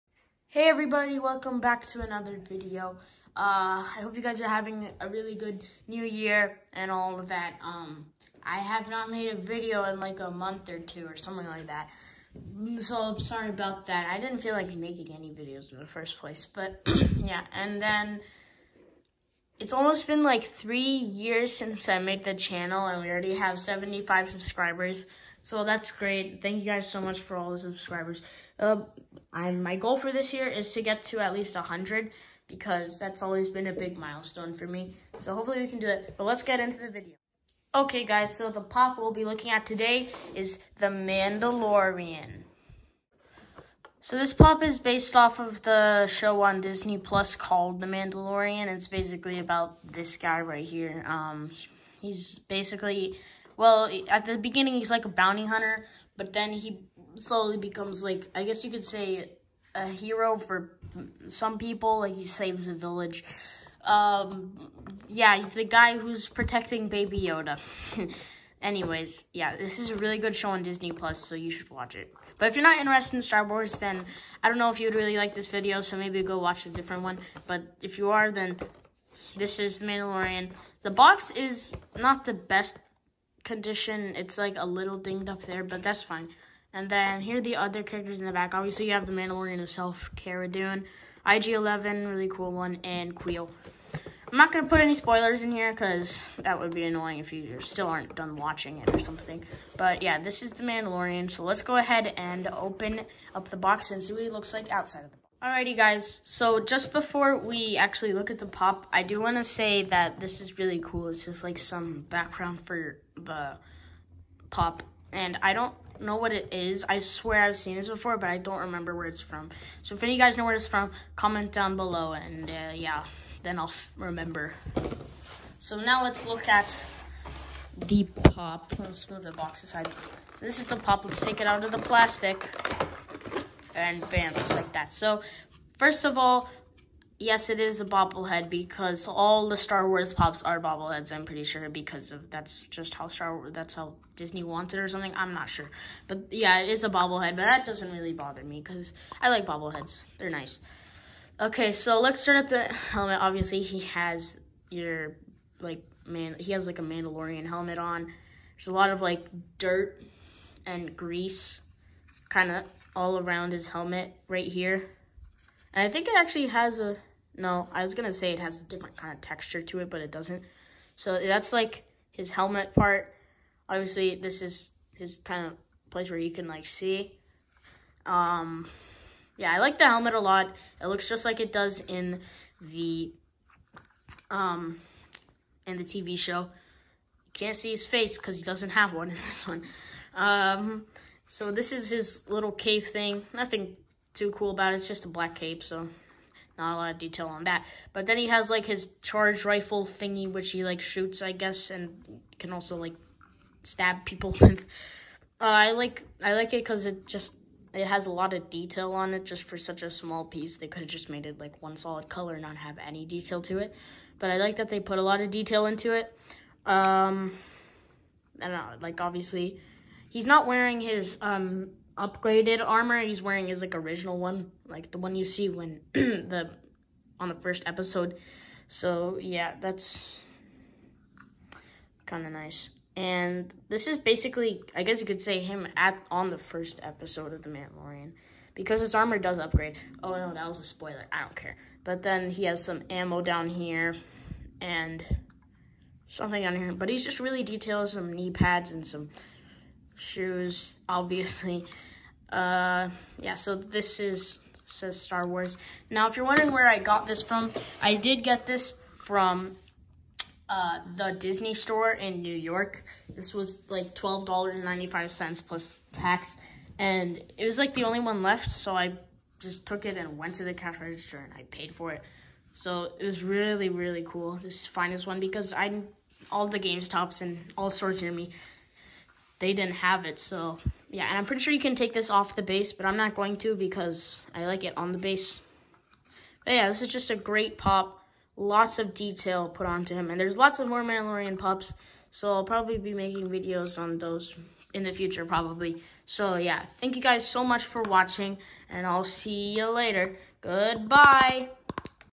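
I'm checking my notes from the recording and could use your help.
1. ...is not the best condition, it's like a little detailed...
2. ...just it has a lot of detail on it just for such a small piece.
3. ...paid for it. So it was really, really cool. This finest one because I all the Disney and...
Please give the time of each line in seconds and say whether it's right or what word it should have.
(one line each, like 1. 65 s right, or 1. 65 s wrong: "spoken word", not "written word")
1. 81 s wrong: "dinged", not "detailed"
2. 207 s right
3. 271 s wrong: "GameStops", not "Disney".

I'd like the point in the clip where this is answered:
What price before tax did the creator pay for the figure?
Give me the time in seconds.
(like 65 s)
263 s.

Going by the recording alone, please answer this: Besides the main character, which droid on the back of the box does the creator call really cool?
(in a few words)
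IG-11.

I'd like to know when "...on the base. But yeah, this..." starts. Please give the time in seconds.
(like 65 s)
284 s.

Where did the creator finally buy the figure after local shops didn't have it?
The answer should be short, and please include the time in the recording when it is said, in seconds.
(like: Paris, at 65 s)
Disney store in New York, at 261 s.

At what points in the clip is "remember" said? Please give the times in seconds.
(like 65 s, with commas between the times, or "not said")
118 s, 123 s.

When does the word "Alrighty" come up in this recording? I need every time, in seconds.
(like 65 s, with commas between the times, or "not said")
105 s.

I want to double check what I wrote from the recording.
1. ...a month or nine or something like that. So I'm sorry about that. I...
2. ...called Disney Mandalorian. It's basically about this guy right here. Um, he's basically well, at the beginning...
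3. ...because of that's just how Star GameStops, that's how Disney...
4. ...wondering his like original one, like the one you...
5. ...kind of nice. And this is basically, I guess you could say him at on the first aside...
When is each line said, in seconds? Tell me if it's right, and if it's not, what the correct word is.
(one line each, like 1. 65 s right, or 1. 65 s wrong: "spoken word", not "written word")
1. 10 s wrong: "two", not "nine"
2. 47 s wrong: "The", not "Disney"
3. 141 s wrong: "Wars", not "GameStops"
4. 223 s wrong: "wearing", not "wondering"
5. 232 s wrong: "episode", not "aside".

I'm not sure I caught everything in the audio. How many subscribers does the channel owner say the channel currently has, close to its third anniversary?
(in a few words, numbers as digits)
75.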